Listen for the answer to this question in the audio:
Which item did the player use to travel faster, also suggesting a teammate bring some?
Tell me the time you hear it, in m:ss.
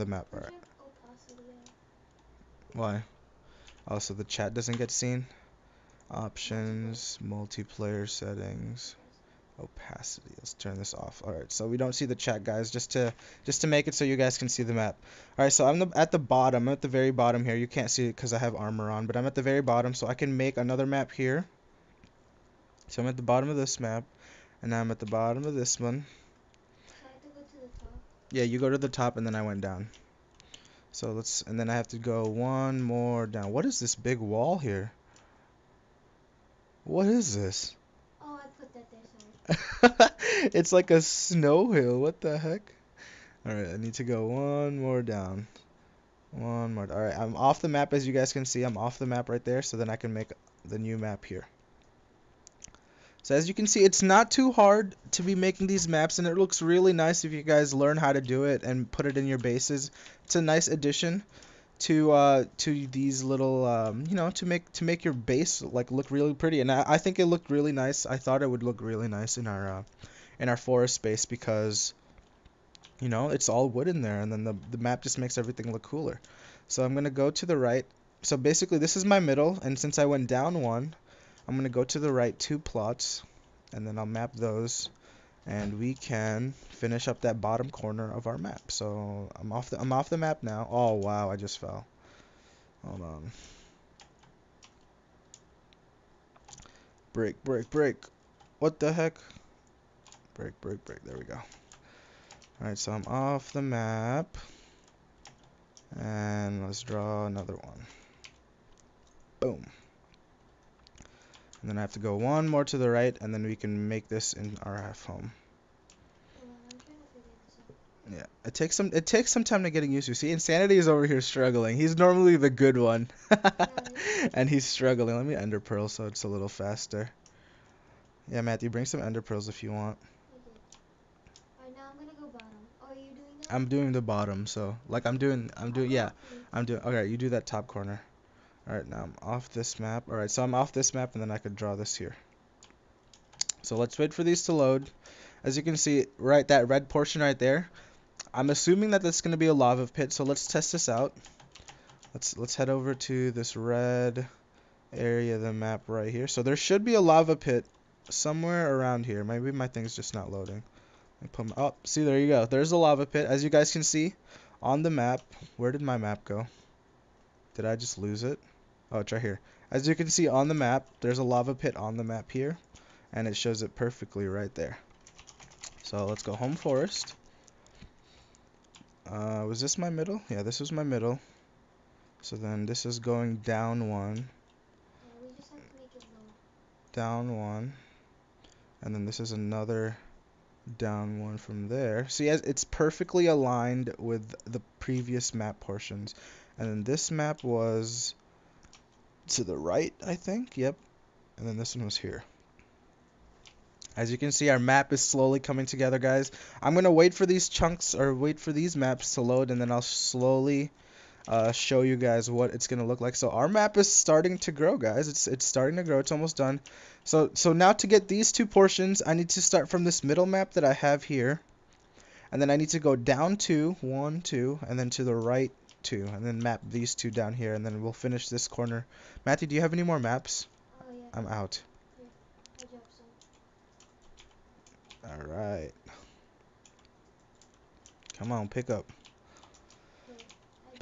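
2:05.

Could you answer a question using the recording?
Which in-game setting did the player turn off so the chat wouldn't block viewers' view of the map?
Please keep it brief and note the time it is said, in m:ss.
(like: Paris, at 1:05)
Opacity, at 0:09.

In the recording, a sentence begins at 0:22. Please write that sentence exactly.
So I'm at the bottom of this map, and I'm at the bottom of this one.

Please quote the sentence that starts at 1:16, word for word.
So I'm gonna go to the right.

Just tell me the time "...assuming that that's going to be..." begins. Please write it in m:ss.
2:28.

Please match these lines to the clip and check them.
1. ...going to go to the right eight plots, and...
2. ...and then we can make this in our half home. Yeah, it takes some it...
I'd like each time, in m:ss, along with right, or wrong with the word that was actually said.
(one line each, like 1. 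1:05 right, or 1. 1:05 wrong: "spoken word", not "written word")
1. 1:21 wrong: "two", not "eight"
2. 1:53 right.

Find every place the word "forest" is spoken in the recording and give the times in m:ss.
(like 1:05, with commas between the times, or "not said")
1:10, 2:56.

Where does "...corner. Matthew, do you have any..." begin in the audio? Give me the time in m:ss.
3:48.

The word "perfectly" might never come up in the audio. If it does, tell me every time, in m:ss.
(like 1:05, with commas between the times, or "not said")
2:53, 3:12.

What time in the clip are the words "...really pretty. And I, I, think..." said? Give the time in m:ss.
1:06.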